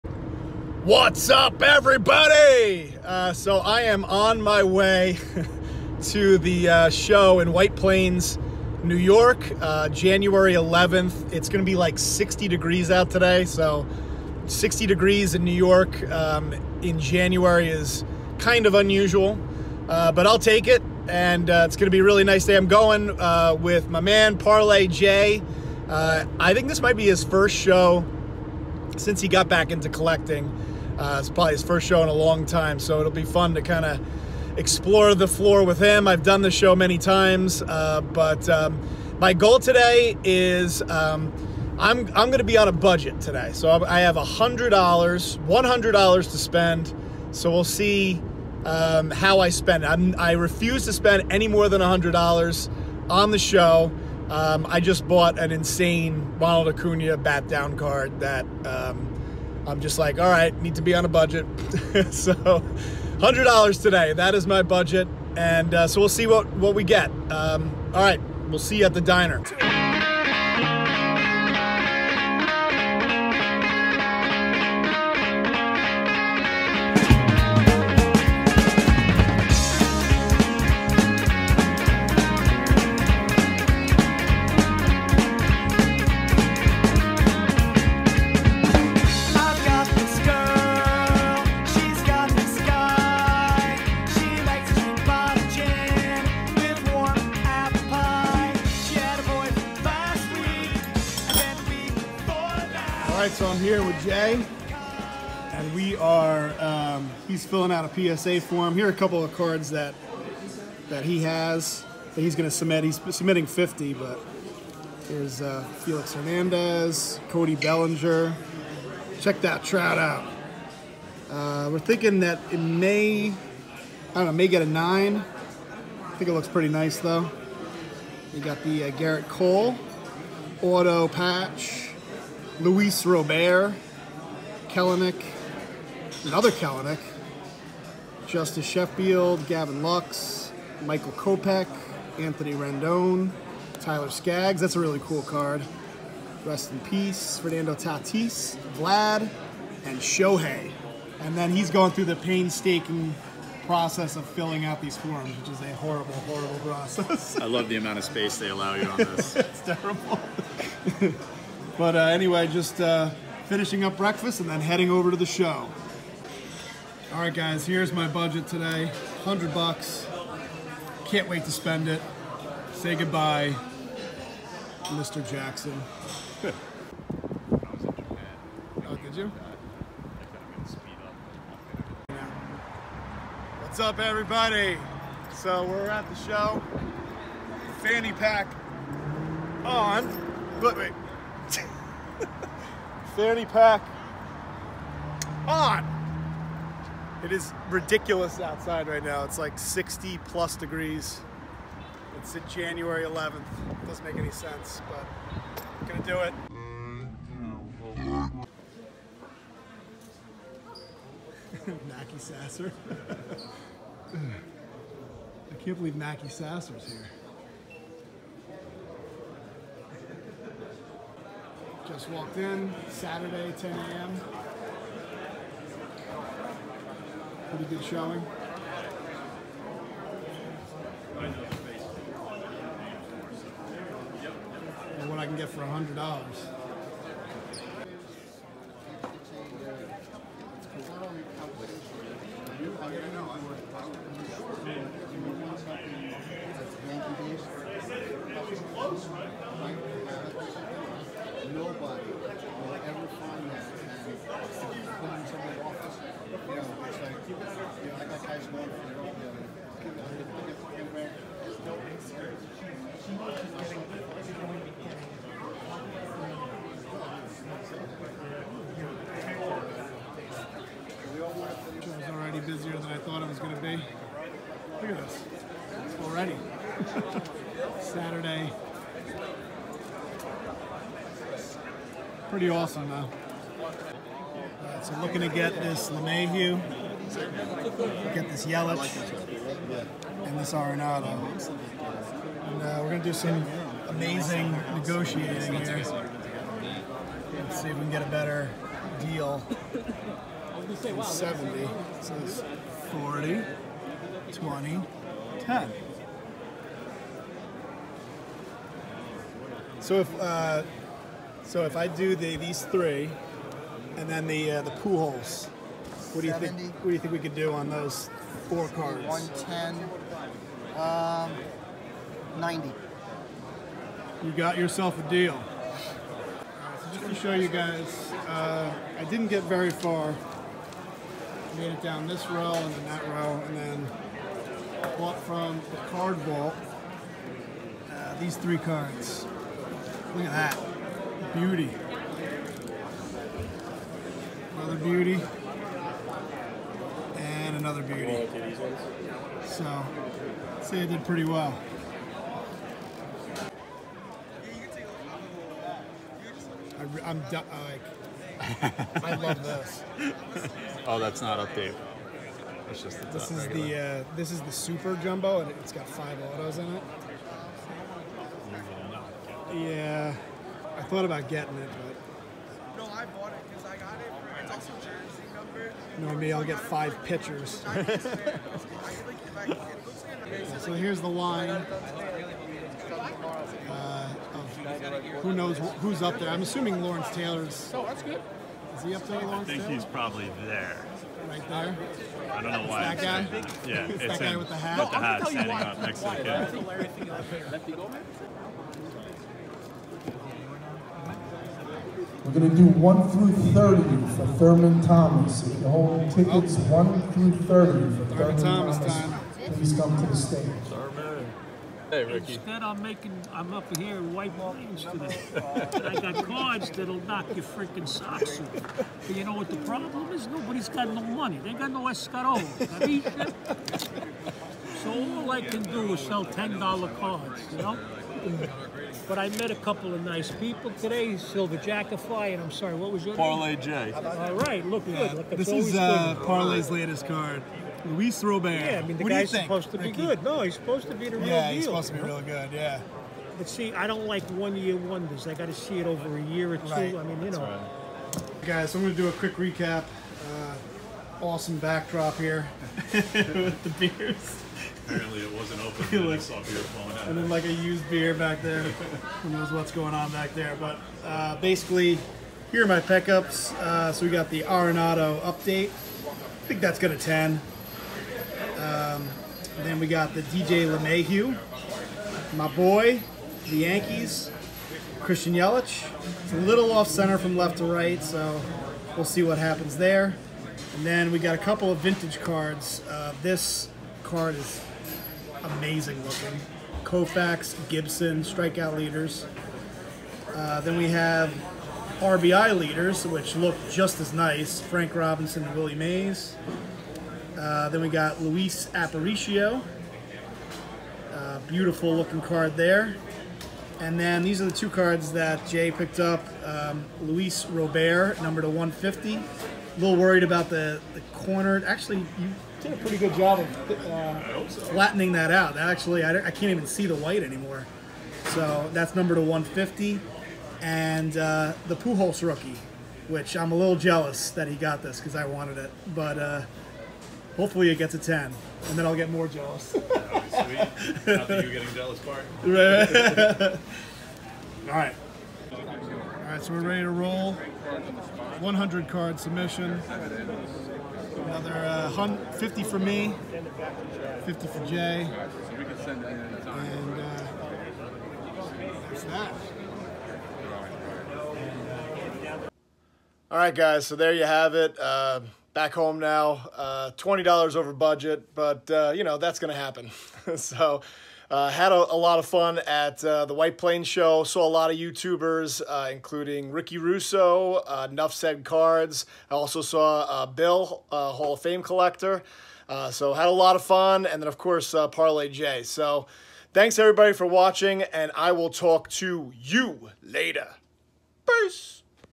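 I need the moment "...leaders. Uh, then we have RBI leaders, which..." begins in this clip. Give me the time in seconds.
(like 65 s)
488 s.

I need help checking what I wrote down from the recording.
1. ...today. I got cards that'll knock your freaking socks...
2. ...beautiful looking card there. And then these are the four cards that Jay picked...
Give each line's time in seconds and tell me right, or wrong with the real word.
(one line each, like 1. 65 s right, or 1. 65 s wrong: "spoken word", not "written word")
1. 414 s right
2. 501 s wrong: "two", not "four".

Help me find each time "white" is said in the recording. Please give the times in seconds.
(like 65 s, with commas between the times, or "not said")
7 s, 414 s, 516 s, 563 s.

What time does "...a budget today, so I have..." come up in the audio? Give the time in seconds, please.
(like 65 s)
42 s.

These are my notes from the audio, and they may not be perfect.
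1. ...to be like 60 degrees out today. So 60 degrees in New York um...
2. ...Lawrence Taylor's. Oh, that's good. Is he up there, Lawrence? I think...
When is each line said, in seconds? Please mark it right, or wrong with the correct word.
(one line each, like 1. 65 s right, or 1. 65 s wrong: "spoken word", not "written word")
1. 11 s right
2. 386 s right.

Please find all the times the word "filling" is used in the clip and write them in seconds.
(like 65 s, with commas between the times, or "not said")
107 s, 154 s.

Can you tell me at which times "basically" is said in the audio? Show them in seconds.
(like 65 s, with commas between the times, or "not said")
461 s.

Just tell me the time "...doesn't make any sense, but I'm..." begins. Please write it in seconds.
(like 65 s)
203 s.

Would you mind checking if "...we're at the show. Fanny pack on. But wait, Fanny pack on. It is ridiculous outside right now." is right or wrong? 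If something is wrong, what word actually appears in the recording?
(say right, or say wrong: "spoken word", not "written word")
right.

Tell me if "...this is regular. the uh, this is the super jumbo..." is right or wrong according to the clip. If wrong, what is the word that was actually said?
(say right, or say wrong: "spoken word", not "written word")
right.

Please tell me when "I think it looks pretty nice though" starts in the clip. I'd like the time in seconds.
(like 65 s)
126 s.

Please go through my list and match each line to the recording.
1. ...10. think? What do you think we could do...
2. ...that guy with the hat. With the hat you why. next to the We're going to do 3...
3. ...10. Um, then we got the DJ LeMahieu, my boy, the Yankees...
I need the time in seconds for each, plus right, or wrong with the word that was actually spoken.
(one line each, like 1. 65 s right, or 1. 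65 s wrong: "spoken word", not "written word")
1. 316 s wrong: "70", not "10"
2. 393 s wrong: "1", not "3"
3. 466 s right.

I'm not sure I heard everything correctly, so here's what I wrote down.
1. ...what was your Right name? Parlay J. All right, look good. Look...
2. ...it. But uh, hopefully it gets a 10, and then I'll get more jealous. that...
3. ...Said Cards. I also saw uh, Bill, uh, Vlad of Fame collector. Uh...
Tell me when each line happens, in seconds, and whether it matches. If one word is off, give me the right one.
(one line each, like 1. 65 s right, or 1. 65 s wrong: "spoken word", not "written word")
1. 432 s wrong: "Parlay", not "Right"
2. 525 s right
3. 568 s wrong: "Hall", not "Vlad".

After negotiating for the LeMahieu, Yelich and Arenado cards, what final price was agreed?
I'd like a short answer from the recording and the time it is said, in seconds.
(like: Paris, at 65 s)
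90, at 322 s.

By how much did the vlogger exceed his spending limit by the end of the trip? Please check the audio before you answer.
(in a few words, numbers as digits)
$20.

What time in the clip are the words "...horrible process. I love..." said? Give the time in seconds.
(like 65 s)
156 s.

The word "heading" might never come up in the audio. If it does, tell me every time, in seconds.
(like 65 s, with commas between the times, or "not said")
164 s.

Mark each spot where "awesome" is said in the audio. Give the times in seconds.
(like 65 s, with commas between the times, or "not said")
282 s, 451 s.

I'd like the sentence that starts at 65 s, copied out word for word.
And uh, so we'll see what, what we get.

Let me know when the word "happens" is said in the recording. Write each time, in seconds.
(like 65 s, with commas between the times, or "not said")
479 s, 559 s.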